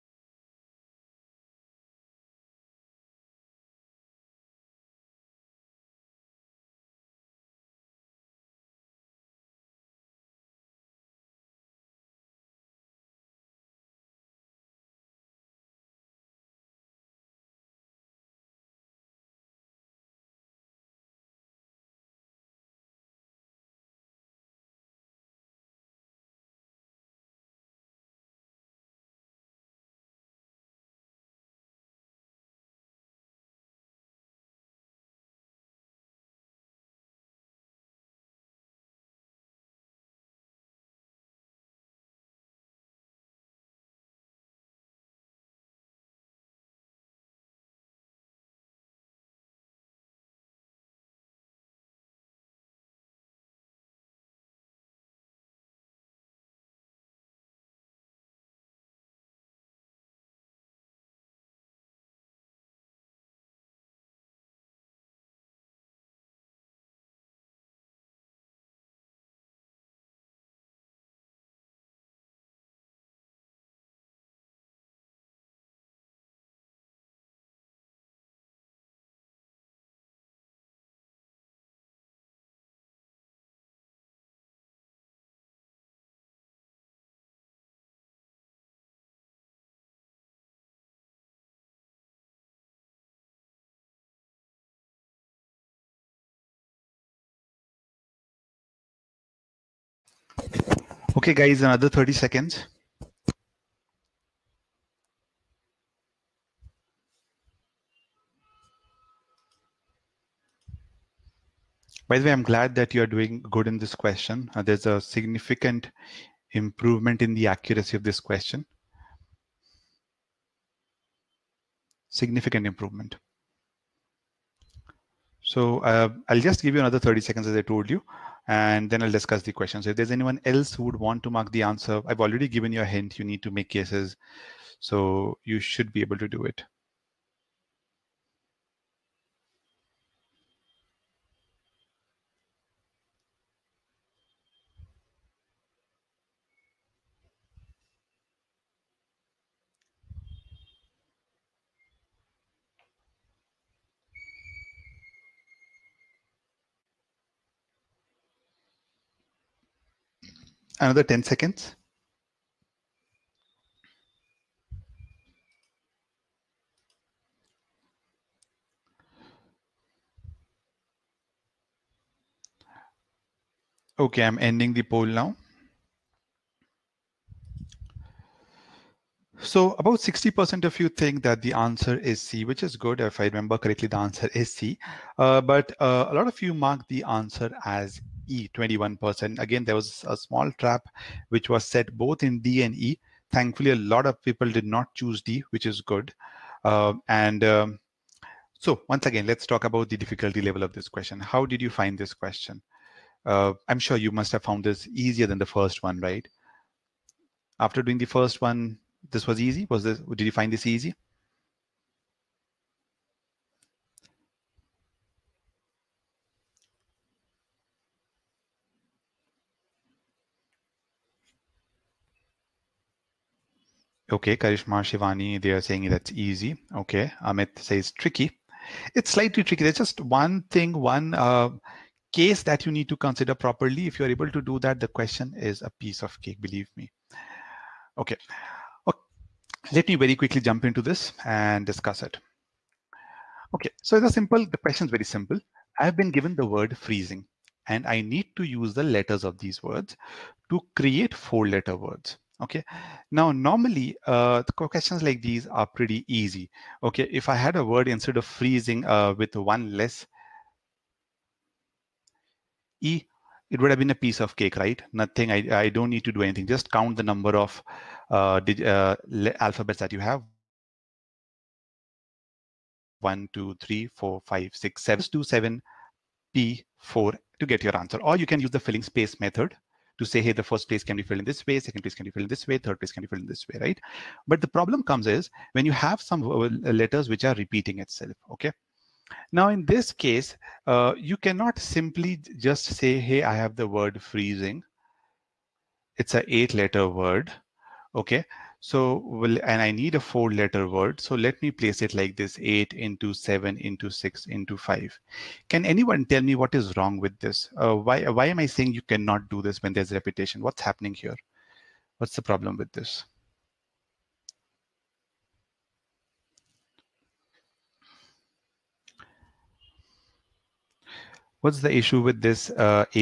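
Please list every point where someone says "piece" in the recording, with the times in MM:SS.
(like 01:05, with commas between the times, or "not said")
03:55, 04:23.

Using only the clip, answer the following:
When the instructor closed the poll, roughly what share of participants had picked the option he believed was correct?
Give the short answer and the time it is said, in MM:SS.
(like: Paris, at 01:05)
60%, at 02:59.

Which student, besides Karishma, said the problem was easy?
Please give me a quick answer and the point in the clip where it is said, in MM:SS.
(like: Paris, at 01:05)
Shivani, at 03:44.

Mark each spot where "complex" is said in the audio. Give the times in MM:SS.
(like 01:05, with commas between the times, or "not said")
not said.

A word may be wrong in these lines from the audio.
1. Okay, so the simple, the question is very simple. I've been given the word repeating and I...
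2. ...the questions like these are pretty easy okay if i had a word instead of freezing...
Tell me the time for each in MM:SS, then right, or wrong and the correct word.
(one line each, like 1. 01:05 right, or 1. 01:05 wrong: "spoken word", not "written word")
1. 04:03 wrong: "freezing", not "repeating"
2. 04:14 right.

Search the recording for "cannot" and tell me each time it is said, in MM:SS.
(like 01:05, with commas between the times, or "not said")
04:51, 05:08.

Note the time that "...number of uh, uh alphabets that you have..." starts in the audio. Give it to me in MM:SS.
04:27.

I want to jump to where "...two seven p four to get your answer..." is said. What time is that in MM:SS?
04:35.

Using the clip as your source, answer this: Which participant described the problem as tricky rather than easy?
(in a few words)
Amit.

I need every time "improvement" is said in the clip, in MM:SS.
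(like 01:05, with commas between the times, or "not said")
01:56, 02:02.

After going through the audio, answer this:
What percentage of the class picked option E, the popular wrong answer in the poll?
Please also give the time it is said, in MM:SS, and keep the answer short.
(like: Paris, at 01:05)
21%, at 03:08.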